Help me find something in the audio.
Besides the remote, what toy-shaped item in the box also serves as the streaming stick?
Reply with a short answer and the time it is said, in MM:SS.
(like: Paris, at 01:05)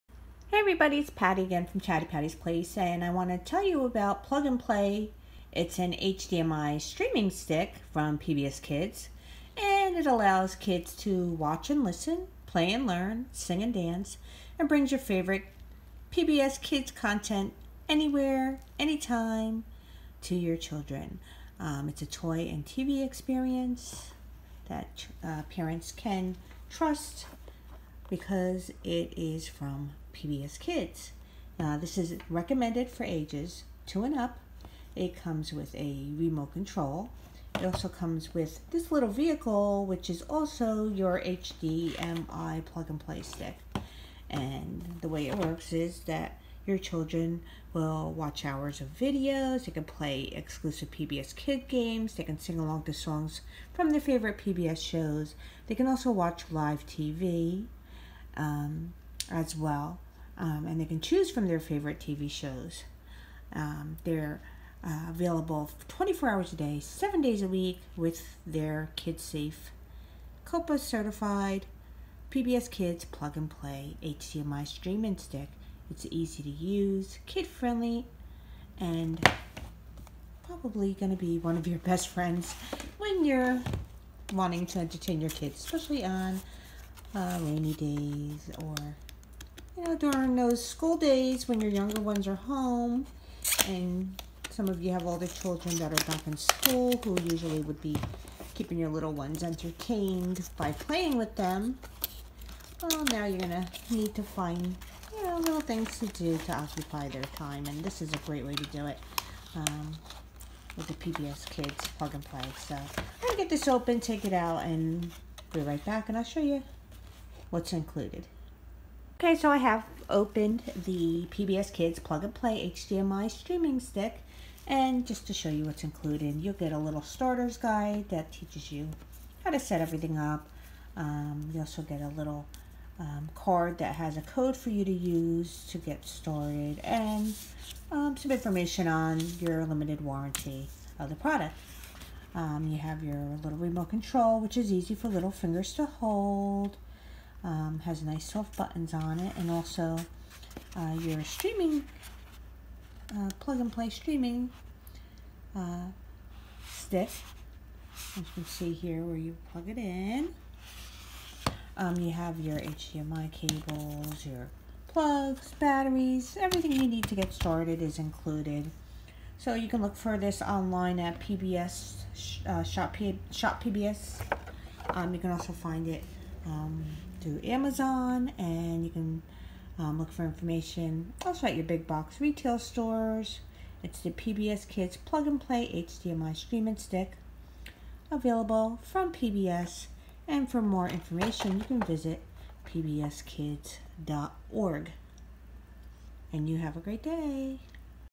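vehicle, at 00:39.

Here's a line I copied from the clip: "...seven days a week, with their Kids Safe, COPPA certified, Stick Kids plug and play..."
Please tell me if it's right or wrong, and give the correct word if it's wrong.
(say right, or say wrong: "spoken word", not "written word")
wrong: "PBS", not "Stick".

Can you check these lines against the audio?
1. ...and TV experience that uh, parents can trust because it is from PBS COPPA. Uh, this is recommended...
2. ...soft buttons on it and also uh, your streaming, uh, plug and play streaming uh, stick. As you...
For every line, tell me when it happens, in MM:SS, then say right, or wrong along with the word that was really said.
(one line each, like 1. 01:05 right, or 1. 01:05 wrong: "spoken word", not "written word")
1. 00:22 wrong: "Kids", not "COPPA"
2. 02:28 right.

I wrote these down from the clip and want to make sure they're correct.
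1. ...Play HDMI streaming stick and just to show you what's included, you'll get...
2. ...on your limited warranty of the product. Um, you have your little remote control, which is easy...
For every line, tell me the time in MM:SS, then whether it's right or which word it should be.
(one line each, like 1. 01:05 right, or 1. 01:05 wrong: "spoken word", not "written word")
1. 02:02 right
2. 02:18 right.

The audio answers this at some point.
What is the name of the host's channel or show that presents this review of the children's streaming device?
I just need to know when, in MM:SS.
00:01.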